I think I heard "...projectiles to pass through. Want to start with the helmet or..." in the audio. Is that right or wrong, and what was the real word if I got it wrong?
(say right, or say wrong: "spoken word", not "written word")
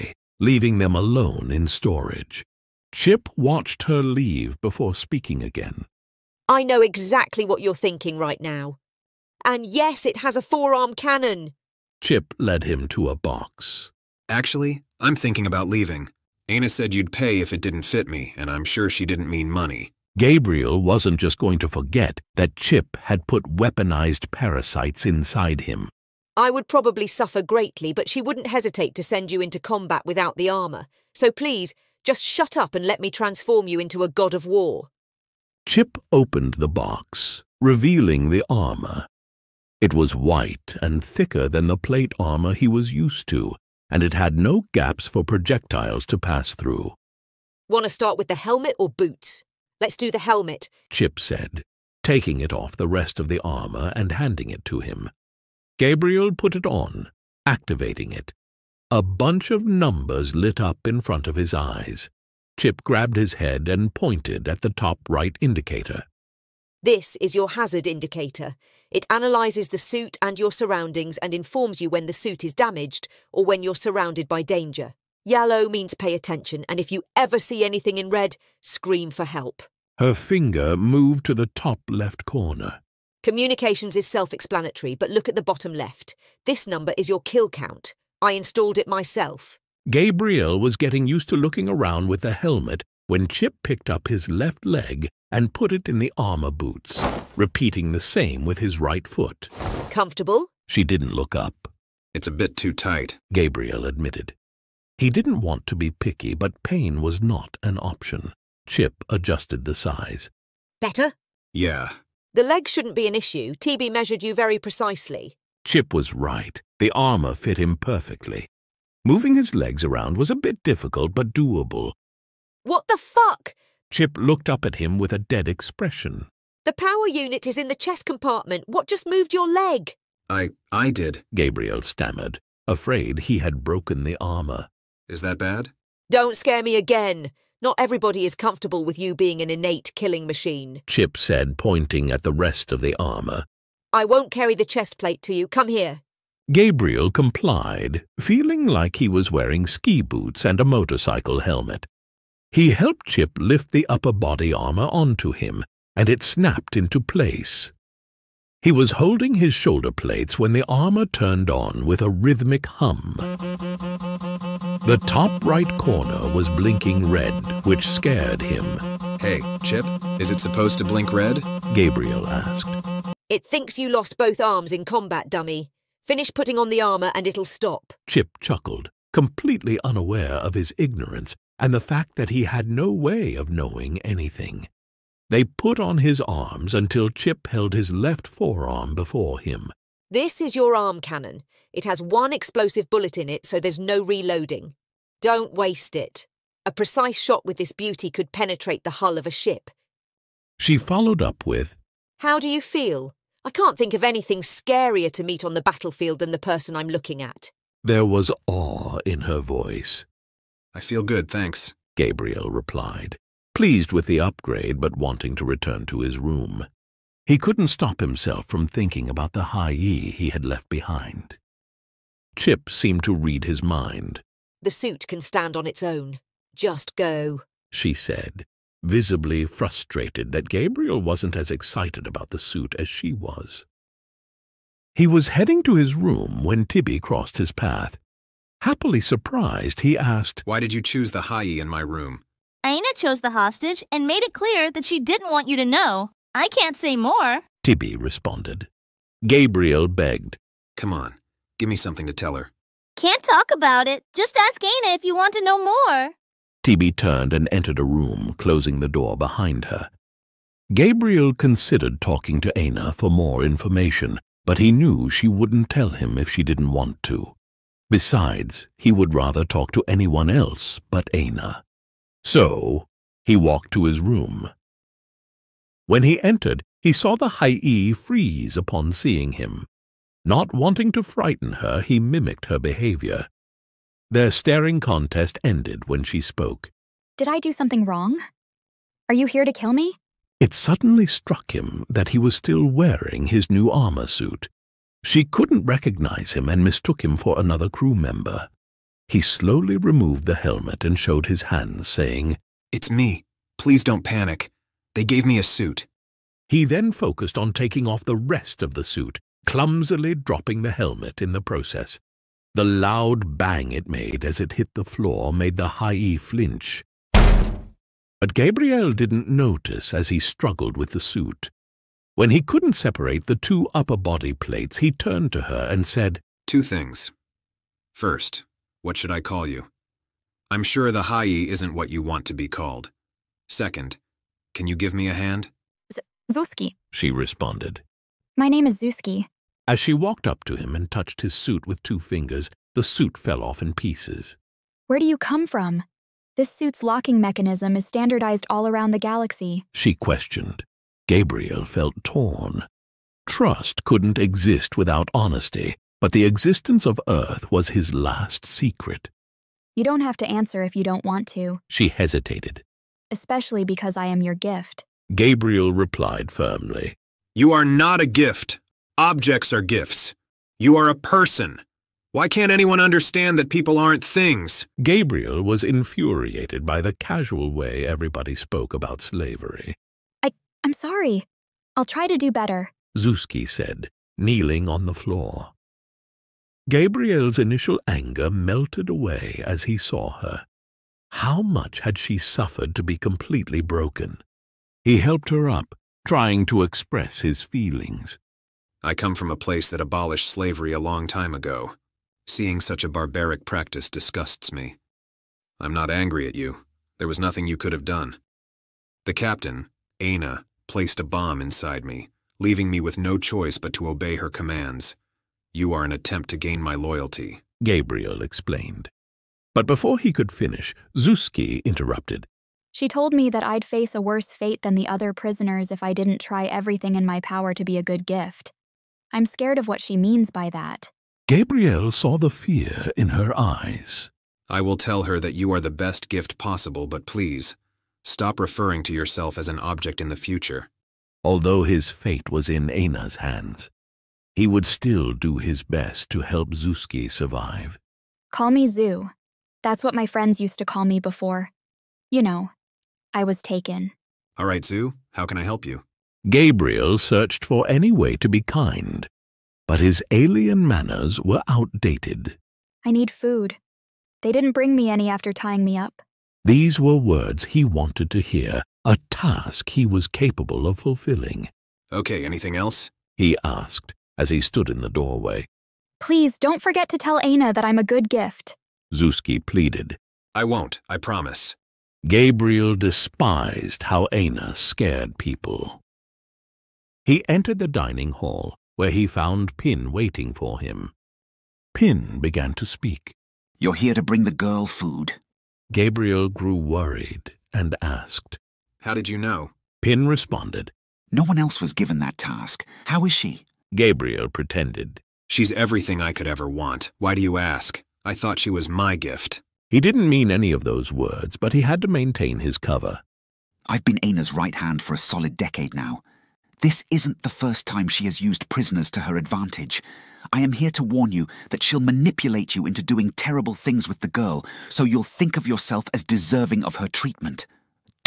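right.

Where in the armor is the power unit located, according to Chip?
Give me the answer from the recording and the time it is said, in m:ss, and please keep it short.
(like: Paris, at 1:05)
Chest compartment, at 2:07.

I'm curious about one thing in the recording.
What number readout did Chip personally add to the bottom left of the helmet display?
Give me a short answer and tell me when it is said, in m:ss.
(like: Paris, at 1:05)
Kill count, at 1:27.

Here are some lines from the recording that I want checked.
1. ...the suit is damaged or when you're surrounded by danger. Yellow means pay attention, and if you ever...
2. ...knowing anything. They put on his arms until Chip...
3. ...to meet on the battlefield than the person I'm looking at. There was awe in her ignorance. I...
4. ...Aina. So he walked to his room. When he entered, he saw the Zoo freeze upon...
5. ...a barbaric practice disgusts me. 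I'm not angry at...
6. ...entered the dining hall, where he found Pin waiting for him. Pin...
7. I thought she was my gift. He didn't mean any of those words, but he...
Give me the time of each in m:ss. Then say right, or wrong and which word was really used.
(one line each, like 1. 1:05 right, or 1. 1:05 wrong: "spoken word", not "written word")
1. 1:12 right
2. 3:03 right
3. 3:25 wrong: "voice", not "ignorance"
4. 4:31 wrong: "Hai", not "Zoo"
5. 6:42 right
6. 8:07 right
7. 8:28 right.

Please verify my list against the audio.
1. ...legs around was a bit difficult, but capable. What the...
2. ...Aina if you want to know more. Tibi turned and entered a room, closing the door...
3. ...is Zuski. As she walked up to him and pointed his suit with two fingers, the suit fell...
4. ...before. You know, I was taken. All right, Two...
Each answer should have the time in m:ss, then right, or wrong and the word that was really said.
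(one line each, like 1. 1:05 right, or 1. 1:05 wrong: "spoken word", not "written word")
1. 1:59 wrong: "doable", not "capable"
2. 4:14 right
3. 5:38 wrong: "touched", not "pointed"
4. 7:30 wrong: "Zoo", not "Two".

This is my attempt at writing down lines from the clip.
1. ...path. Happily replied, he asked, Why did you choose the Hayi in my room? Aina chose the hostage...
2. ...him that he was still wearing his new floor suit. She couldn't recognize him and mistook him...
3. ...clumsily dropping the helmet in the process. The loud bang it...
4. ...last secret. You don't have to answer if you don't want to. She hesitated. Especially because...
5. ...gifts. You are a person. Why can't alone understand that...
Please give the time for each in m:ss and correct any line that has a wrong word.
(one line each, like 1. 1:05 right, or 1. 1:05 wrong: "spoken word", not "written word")
1. 3:57 wrong: "surprised", not "replied"
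2. 4:51 wrong: "armor", not "floor"
3. 5:09 right
4. 5:57 right
5. 6:09 wrong: "anyone", not "alone".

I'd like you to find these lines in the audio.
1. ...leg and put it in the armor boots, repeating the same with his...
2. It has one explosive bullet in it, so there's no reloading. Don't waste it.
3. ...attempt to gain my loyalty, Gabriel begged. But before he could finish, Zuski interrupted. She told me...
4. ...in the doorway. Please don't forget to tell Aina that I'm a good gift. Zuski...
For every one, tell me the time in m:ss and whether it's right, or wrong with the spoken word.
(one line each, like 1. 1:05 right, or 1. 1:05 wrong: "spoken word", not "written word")
1. 1:34 right
2. 3:11 right
3. 6:55 wrong: "explained", not "begged"
4. 7:54 right.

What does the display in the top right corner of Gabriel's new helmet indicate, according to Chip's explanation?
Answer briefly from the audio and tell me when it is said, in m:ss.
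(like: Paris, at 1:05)
Hazard indicator, at 1:07.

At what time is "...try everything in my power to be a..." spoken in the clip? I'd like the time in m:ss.
7:06.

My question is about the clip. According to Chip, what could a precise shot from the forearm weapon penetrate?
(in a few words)
The hull of a ship.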